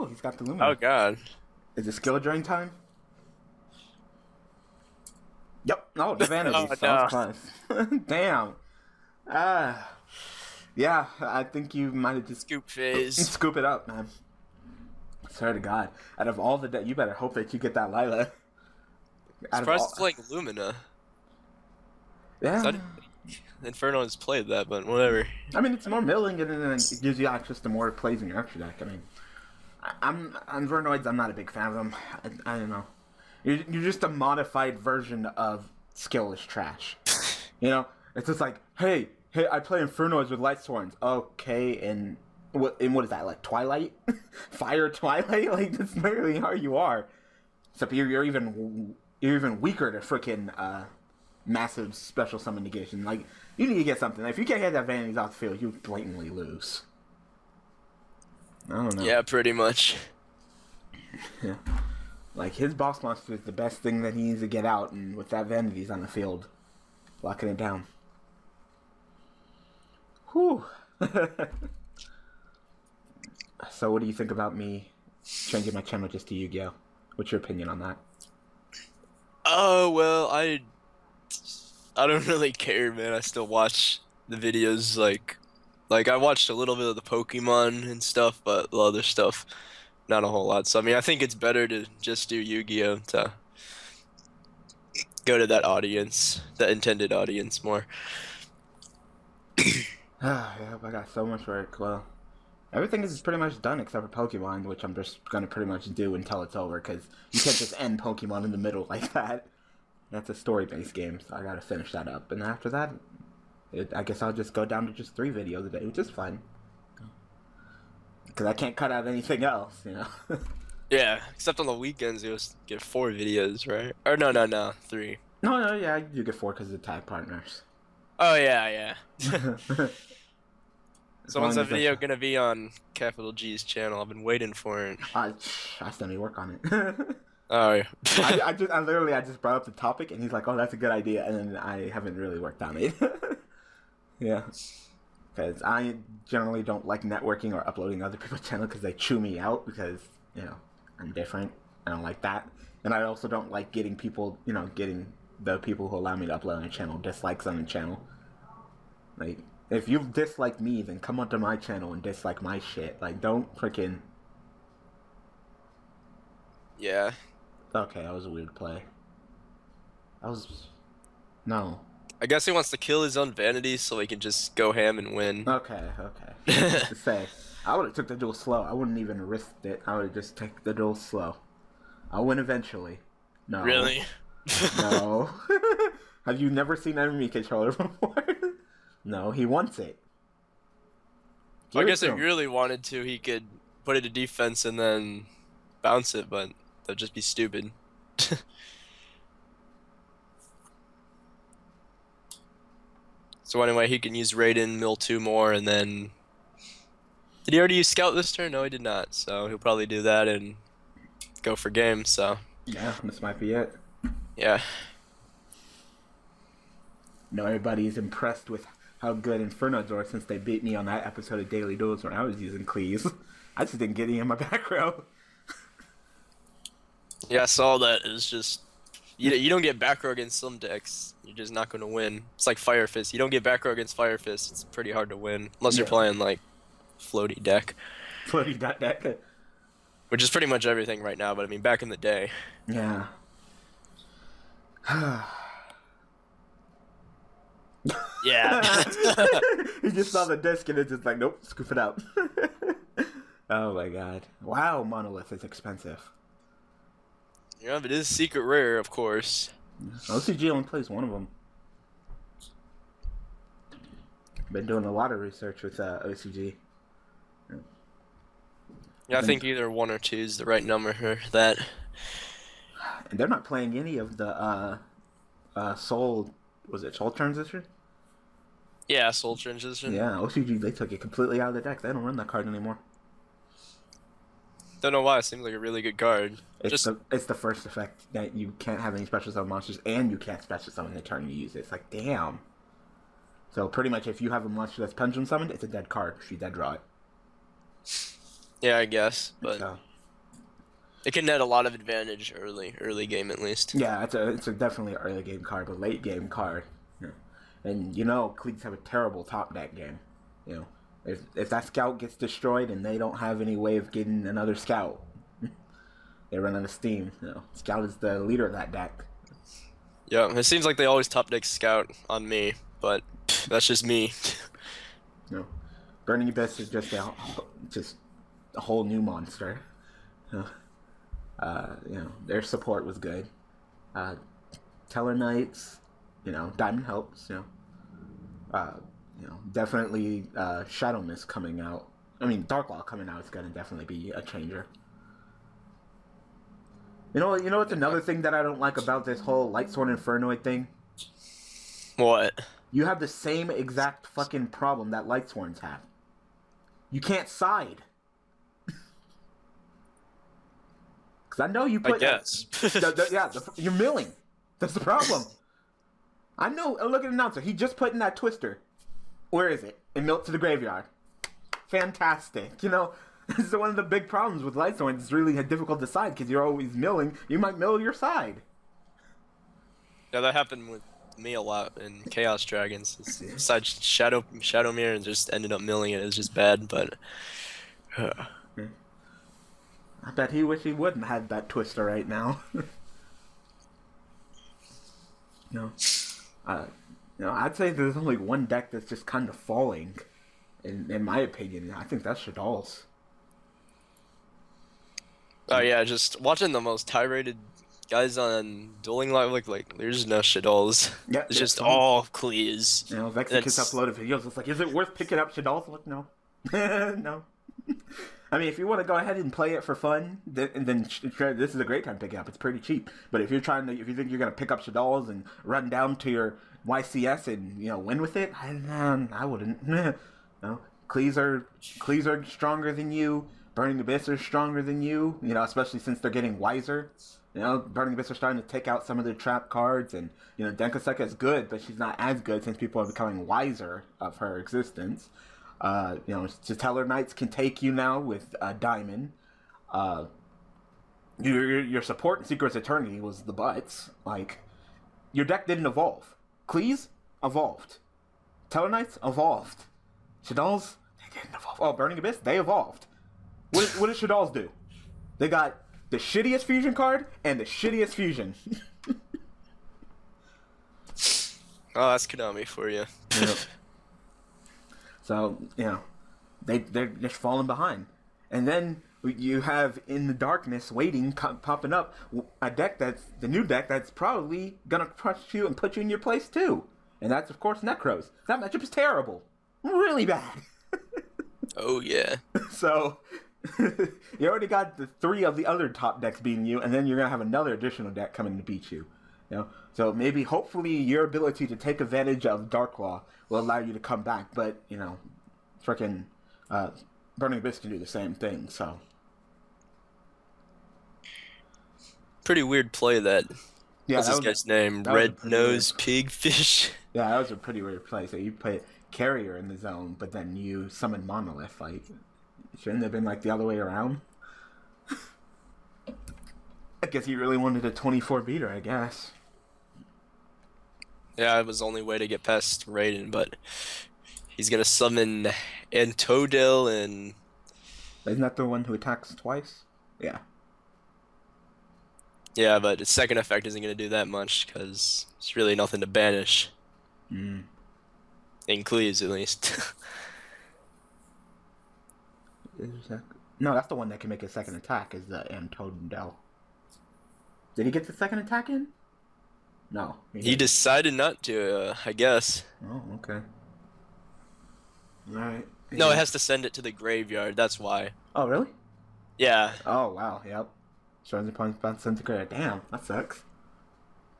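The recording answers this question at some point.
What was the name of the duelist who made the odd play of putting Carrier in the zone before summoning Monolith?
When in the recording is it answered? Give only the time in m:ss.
8:34.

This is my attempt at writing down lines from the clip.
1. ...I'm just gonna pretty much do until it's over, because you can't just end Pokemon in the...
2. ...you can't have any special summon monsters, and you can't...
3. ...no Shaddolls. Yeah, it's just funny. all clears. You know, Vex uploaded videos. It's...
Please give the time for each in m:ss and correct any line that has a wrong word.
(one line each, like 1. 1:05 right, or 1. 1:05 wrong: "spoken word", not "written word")
1. 1:44 right
2. 4:48 right
3. 6:50 right.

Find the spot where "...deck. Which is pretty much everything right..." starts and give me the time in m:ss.
3:58.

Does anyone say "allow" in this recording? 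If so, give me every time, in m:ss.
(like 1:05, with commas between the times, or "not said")
2:35, 8:23.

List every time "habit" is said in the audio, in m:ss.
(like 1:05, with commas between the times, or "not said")
not said.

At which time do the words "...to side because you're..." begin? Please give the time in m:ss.
6:15.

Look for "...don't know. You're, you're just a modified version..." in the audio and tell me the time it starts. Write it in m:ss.
0:32.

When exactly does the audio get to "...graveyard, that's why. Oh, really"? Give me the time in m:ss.
9:26.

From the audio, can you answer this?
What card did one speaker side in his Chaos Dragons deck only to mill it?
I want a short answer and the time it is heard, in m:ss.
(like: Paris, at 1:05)
Shadow Mirror, at 6:24.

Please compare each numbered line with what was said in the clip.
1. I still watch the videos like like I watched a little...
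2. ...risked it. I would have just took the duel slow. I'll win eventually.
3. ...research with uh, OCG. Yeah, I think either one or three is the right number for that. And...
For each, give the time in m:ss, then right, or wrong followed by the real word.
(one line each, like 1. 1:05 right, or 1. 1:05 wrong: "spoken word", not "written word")
1. 1:23 right
2. 2:59 right
3. 4:25 wrong: "two", not "three".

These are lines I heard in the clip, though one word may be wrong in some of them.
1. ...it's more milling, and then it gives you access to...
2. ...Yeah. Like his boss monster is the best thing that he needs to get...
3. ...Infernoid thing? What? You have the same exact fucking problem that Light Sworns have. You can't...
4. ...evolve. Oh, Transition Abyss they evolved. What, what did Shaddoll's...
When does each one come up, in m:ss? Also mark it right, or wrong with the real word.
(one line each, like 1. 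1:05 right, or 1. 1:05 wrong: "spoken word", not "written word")
1. 0:25 right
2. 1:01 right
3. 5:49 right
4. 7:41 wrong: "Burning", not "Transition".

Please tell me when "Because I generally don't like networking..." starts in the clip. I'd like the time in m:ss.
2:25.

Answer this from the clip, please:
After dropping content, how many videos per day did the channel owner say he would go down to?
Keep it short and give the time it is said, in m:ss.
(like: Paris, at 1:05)
3, at 1:55.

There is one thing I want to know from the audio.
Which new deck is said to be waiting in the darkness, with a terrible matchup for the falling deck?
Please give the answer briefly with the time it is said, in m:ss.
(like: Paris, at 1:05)
Nekroz, at 8:07.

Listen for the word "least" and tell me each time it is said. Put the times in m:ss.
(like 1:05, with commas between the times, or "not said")
5:03, 9:09.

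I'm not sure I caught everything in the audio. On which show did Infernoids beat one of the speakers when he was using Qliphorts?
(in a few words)
Daily Duels.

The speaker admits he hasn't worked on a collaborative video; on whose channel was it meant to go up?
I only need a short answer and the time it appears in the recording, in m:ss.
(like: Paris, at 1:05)
Capital G, at 2:12.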